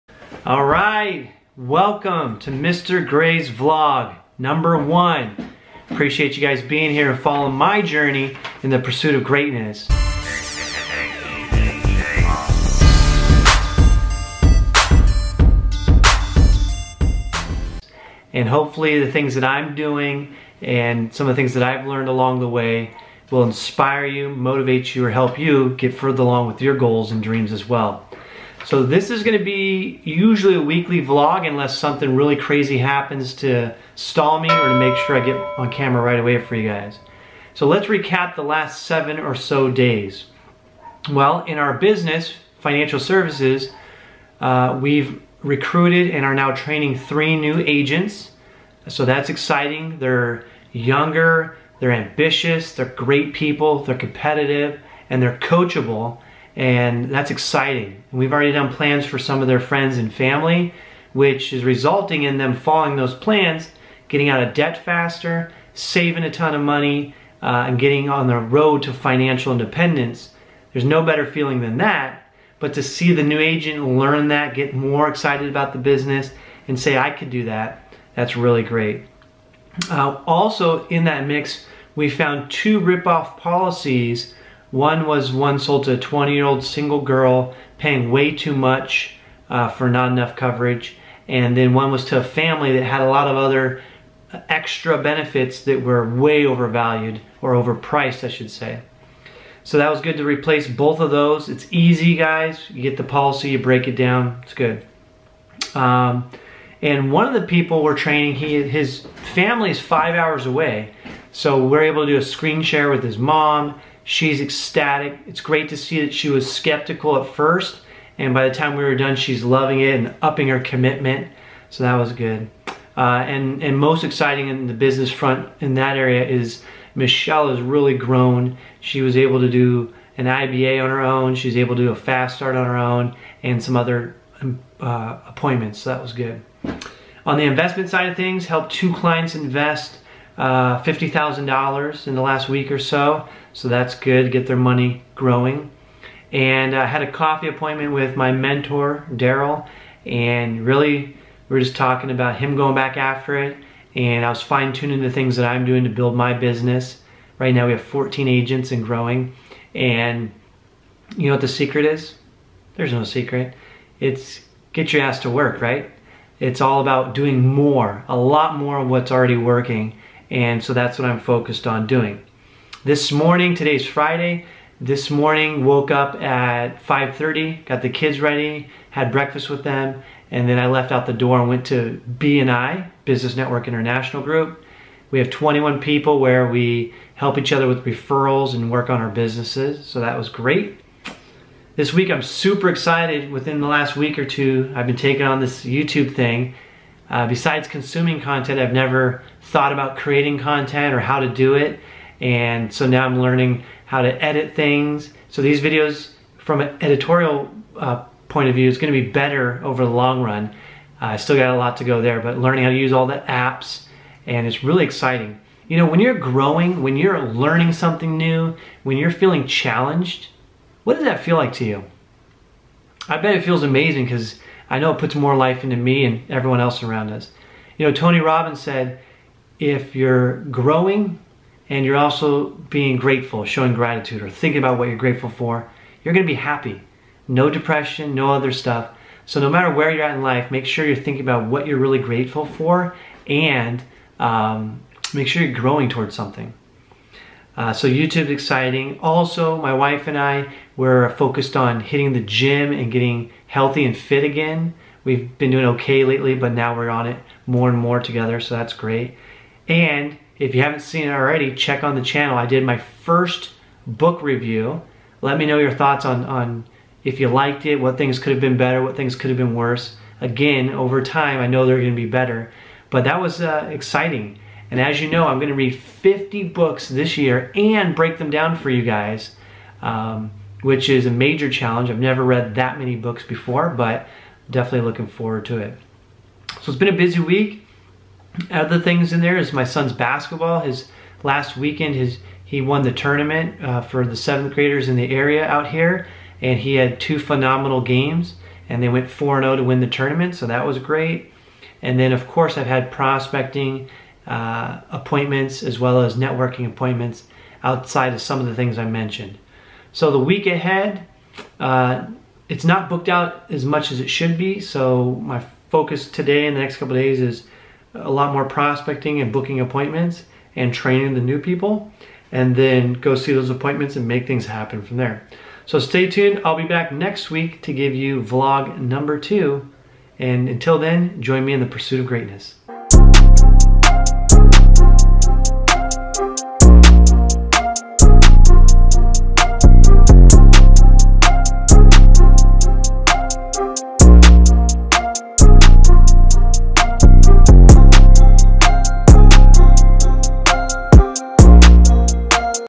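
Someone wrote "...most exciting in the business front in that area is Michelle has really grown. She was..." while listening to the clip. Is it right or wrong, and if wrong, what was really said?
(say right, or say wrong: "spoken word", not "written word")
right.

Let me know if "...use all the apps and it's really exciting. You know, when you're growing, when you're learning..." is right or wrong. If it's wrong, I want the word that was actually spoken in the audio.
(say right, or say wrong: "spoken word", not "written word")
right.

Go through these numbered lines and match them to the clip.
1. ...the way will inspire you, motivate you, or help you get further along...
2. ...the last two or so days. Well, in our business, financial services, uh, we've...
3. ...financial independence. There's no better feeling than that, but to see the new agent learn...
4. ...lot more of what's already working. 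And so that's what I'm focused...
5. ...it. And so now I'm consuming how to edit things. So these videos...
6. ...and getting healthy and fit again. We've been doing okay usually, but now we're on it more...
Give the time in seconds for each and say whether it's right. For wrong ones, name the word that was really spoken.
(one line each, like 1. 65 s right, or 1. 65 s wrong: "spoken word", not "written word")
1. 22 s right
2. 38 s wrong: "seven", not "two"
3. 68 s right
4. 168 s right
5. 201 s wrong: "learning", not "consuming"
6. 252 s wrong: "lately", not "usually".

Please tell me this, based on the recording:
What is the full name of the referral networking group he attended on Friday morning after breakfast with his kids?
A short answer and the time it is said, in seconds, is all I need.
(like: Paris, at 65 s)
Business Network International, at 183 s.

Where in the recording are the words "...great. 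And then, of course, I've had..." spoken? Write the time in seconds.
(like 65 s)
300 s.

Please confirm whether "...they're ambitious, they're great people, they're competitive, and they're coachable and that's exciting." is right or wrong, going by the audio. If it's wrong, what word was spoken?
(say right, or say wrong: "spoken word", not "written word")
right.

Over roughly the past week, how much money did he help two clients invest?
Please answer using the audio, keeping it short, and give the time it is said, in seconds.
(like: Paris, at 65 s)
$50,000, at 140 s.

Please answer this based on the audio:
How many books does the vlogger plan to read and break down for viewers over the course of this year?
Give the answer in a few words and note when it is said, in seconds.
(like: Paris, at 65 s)
50, at 275 s.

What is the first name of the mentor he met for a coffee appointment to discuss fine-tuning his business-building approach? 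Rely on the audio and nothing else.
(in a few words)
Daryl.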